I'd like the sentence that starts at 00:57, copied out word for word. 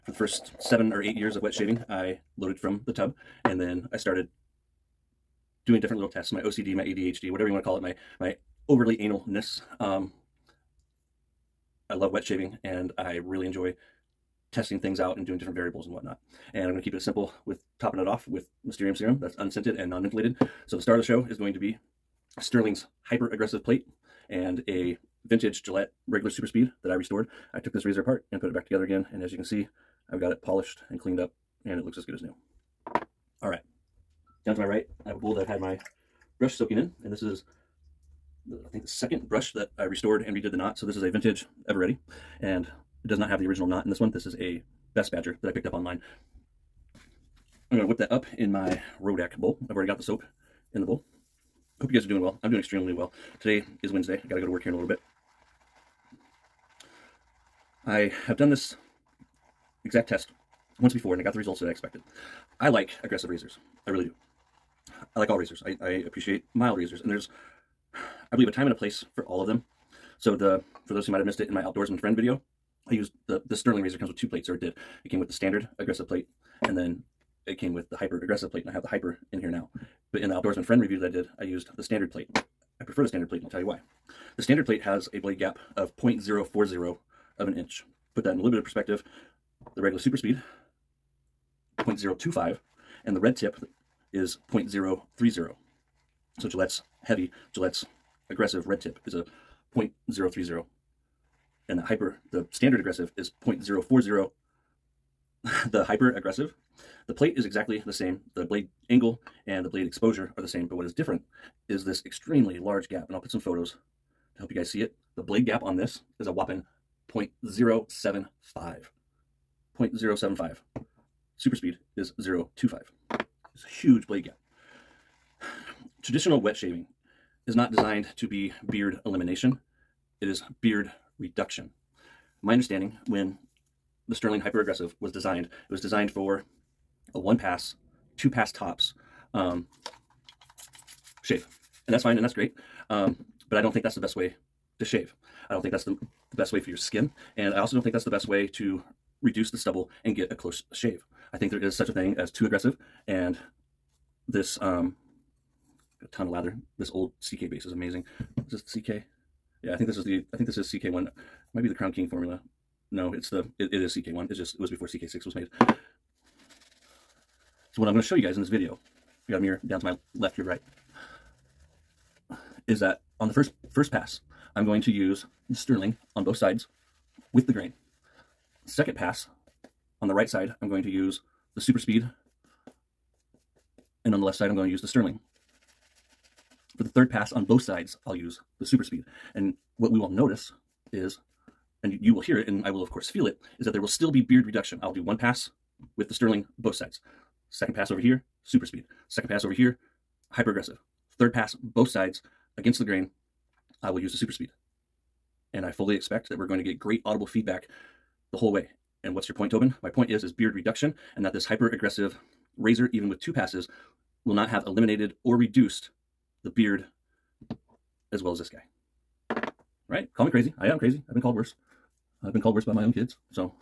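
I have done this exact test once before and I got the results that I expected.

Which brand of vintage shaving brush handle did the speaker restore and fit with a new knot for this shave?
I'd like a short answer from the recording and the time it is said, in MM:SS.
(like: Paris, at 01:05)
Eveready, at 00:41.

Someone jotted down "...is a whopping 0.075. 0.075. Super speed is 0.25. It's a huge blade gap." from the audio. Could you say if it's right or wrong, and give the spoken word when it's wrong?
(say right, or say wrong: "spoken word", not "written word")
right.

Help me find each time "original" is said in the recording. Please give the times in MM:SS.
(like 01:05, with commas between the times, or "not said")
00:43.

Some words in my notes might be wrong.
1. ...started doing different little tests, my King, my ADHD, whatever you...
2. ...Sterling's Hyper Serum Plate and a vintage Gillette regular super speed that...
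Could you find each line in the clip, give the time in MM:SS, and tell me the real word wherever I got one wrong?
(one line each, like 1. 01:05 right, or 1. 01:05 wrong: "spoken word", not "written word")
1. 00:03 wrong: "OCD", not "King"
2. 00:22 wrong: "Aggressive", not "Serum".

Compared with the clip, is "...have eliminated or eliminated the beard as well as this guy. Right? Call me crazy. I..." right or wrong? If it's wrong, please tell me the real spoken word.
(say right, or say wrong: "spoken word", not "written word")
wrong: "reduced", not "eliminated".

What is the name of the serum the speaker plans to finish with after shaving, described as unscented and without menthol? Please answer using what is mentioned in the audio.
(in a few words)
Mysterium Serum.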